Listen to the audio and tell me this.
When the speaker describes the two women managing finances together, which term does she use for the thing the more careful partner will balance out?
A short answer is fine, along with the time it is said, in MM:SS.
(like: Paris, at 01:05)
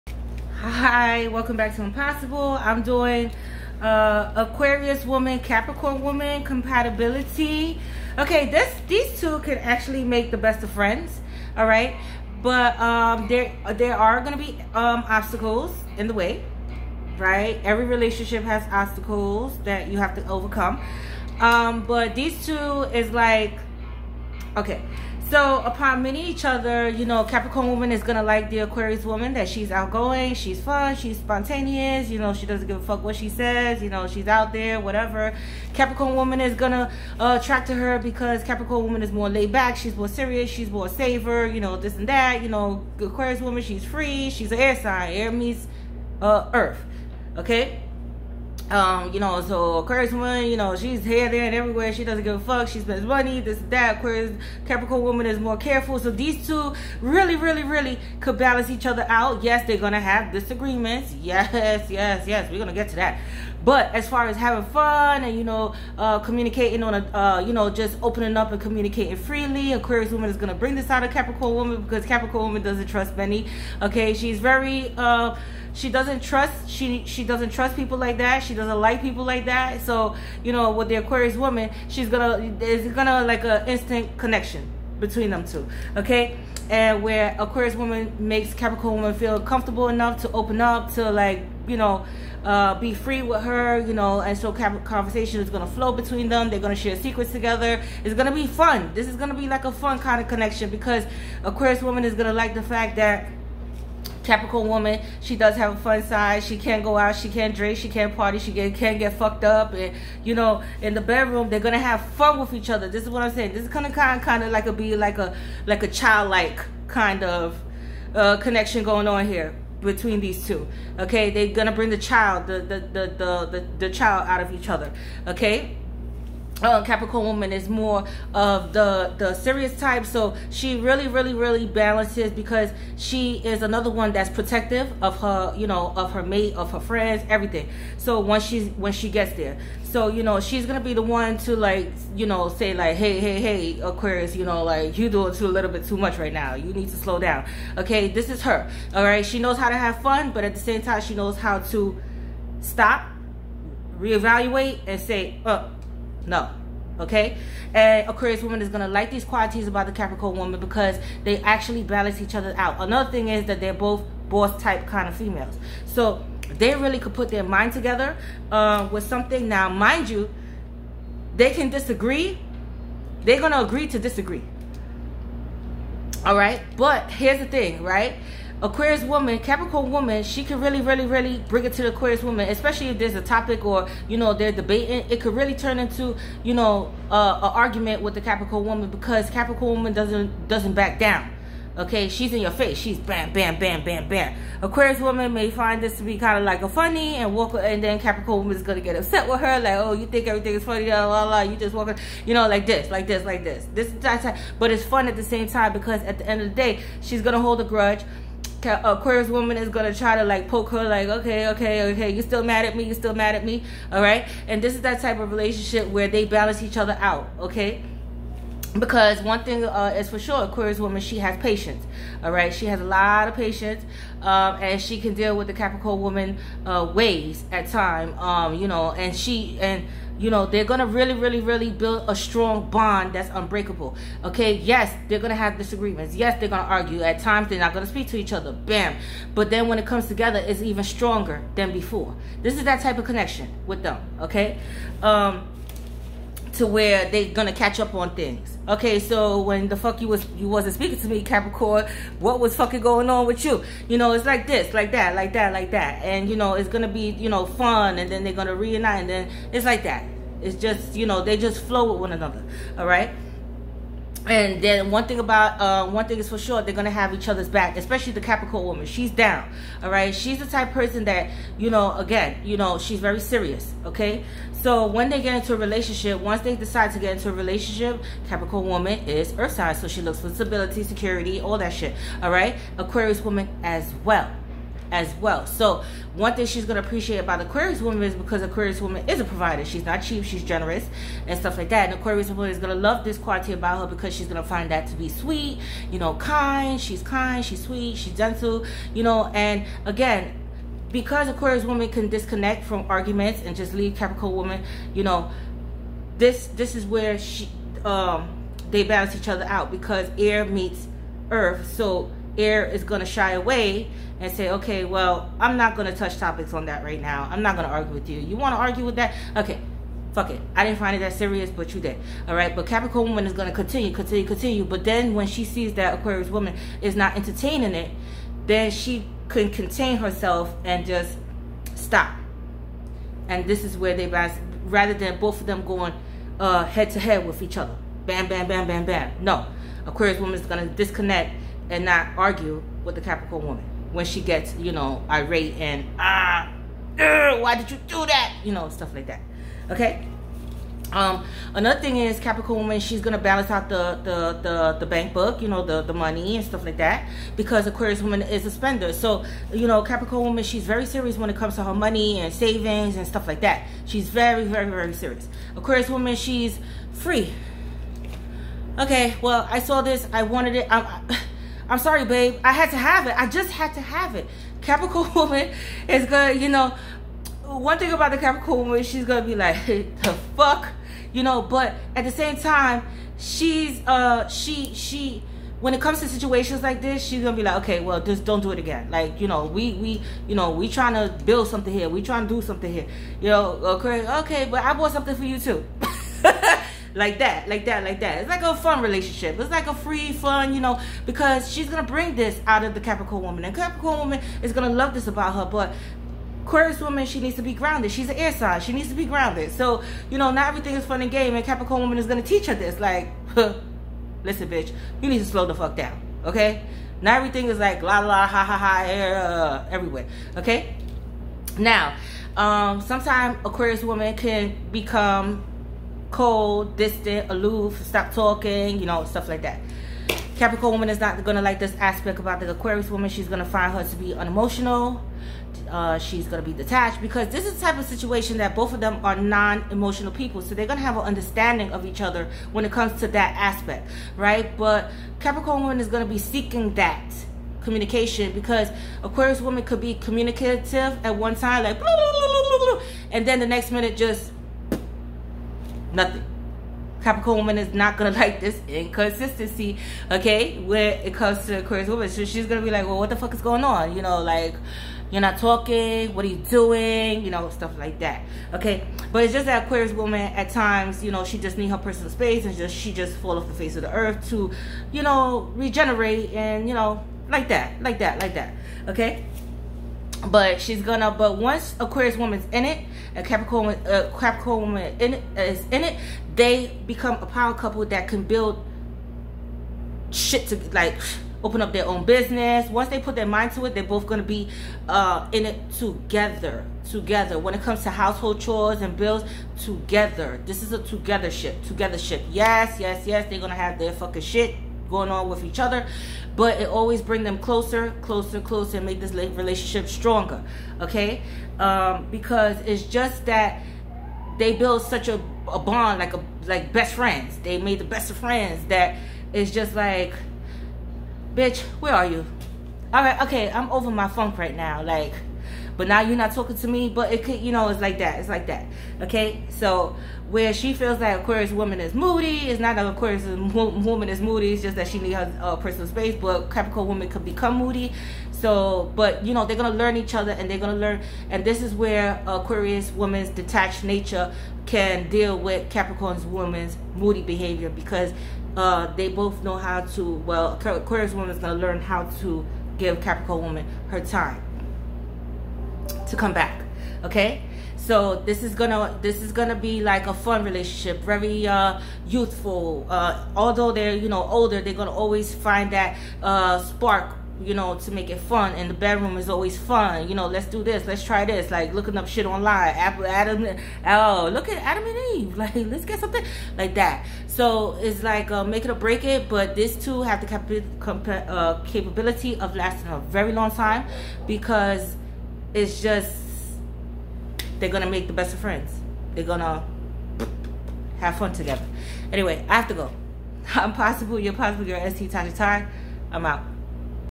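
bank book, at 05:54.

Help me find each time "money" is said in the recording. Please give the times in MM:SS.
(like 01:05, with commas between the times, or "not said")
00:53, 05:55, 06:01.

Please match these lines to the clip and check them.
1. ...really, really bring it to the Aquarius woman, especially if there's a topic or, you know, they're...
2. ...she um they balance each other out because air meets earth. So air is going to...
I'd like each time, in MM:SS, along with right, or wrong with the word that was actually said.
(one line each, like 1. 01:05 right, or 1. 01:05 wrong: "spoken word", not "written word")
1. 03:00 right
2. 05:07 right.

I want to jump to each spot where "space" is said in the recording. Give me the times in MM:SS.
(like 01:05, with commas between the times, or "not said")
07:52, 08:55.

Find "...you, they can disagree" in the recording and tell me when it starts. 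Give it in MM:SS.
02:50.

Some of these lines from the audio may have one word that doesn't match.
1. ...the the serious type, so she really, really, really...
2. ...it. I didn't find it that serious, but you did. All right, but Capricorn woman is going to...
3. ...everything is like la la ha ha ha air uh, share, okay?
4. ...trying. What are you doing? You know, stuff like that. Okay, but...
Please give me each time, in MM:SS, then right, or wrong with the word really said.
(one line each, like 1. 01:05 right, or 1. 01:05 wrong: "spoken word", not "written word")
1. 02:08 right
2. 05:20 right
3. 06:57 wrong: "everywhere", not "share"
4. 07:45 wrong: "talking", not "trying".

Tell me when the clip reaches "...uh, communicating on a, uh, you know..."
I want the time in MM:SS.
01:05.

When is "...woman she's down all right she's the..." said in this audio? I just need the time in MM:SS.
04:28.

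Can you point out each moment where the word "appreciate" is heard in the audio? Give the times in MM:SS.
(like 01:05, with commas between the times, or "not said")
04:46.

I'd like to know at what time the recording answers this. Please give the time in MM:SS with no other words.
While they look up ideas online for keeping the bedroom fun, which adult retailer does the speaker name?
09:35.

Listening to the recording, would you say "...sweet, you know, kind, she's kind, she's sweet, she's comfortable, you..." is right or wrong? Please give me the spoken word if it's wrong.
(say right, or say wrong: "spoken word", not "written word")
wrong: "gentle", not "comfortable".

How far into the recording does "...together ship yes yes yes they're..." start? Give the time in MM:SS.
08:21.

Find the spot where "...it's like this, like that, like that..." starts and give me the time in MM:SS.
04:14.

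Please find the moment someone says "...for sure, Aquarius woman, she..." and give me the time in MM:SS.
03:40.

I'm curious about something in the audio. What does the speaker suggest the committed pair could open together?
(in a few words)
their own business.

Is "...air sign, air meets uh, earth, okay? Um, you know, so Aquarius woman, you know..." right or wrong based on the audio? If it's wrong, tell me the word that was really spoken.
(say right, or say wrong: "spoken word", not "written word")
right.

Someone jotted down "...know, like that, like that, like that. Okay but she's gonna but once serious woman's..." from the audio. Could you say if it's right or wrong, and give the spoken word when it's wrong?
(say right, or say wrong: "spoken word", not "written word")
wrong: "aquarius", not "serious".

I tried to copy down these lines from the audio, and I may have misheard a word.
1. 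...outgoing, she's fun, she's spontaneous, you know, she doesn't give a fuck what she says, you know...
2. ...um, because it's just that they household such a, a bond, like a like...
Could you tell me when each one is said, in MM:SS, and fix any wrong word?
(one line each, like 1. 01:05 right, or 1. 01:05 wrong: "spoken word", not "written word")
1. 00:29 right
2. 08:31 wrong: "build", not "household".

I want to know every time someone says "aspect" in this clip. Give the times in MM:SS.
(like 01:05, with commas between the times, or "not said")
07:11, 07:23.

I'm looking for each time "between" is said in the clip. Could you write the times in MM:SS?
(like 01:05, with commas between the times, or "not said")
01:24, 01:35, 01:59.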